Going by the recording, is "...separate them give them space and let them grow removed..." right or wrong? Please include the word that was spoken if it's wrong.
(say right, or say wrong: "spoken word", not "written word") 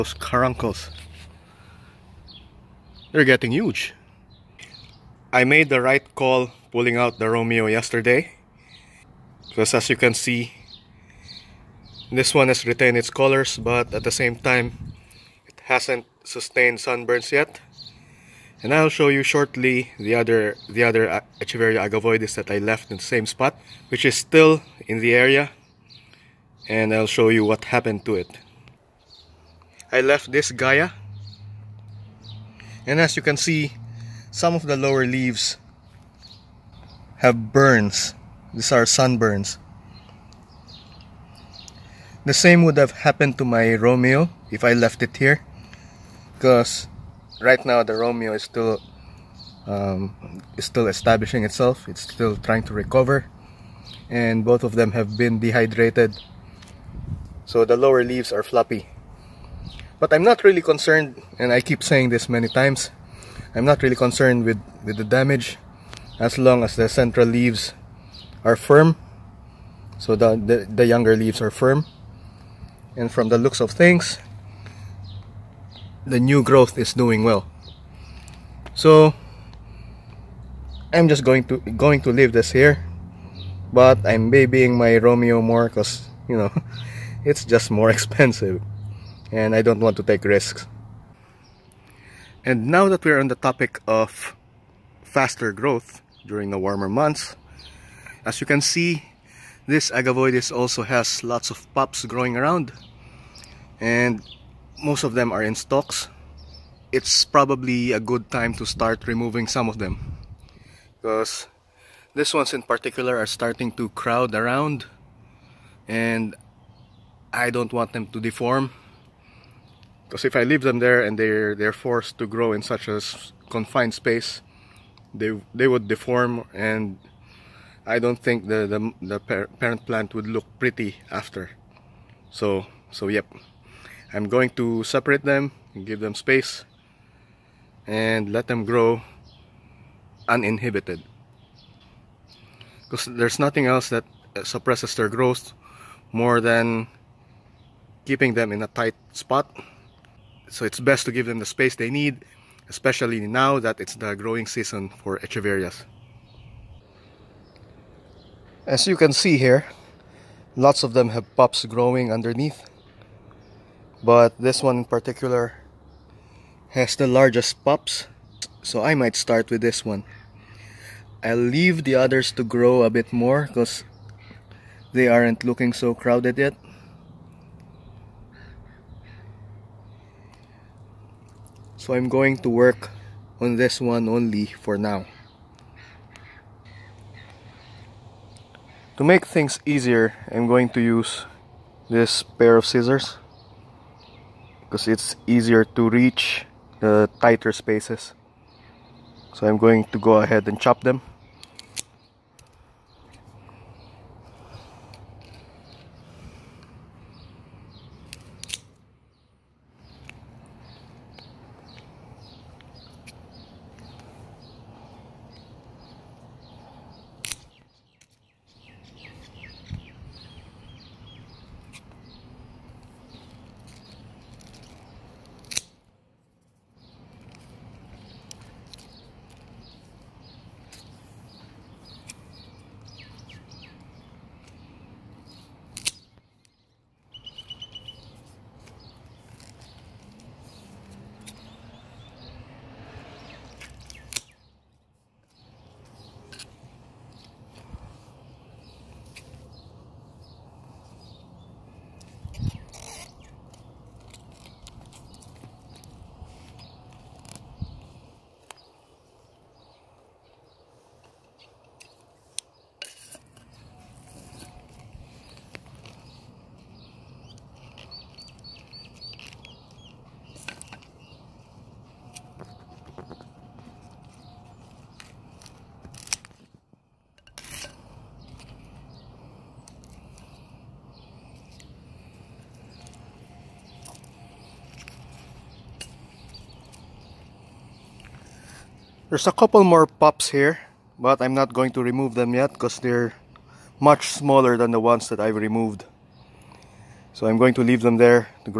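wrong: "uninhibited", not "removed".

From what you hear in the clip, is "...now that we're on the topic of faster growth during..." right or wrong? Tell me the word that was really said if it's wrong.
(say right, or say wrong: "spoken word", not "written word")
right.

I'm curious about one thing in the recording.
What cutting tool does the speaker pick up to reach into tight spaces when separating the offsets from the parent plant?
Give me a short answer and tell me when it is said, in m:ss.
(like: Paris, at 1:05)
scissors, at 3:12.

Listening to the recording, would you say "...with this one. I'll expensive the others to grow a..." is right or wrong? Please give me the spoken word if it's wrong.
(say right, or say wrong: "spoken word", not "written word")
wrong: "leave", not "expensive".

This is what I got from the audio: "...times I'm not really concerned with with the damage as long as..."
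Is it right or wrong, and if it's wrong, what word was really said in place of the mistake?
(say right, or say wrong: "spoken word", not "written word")
right.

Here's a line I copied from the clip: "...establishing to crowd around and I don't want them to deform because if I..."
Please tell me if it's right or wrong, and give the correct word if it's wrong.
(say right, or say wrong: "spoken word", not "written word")
wrong: "starting", not "establishing".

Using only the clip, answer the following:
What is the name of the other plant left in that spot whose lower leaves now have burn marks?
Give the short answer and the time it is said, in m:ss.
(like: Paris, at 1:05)
Gaia, at 0:30.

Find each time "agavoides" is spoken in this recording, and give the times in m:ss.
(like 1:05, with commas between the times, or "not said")
0:21, 1:39.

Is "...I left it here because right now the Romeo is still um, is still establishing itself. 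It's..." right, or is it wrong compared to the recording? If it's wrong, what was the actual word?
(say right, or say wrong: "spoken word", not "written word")
right.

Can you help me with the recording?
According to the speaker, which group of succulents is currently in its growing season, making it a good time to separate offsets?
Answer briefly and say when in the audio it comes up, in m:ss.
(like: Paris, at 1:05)
echeverias, at 2:35.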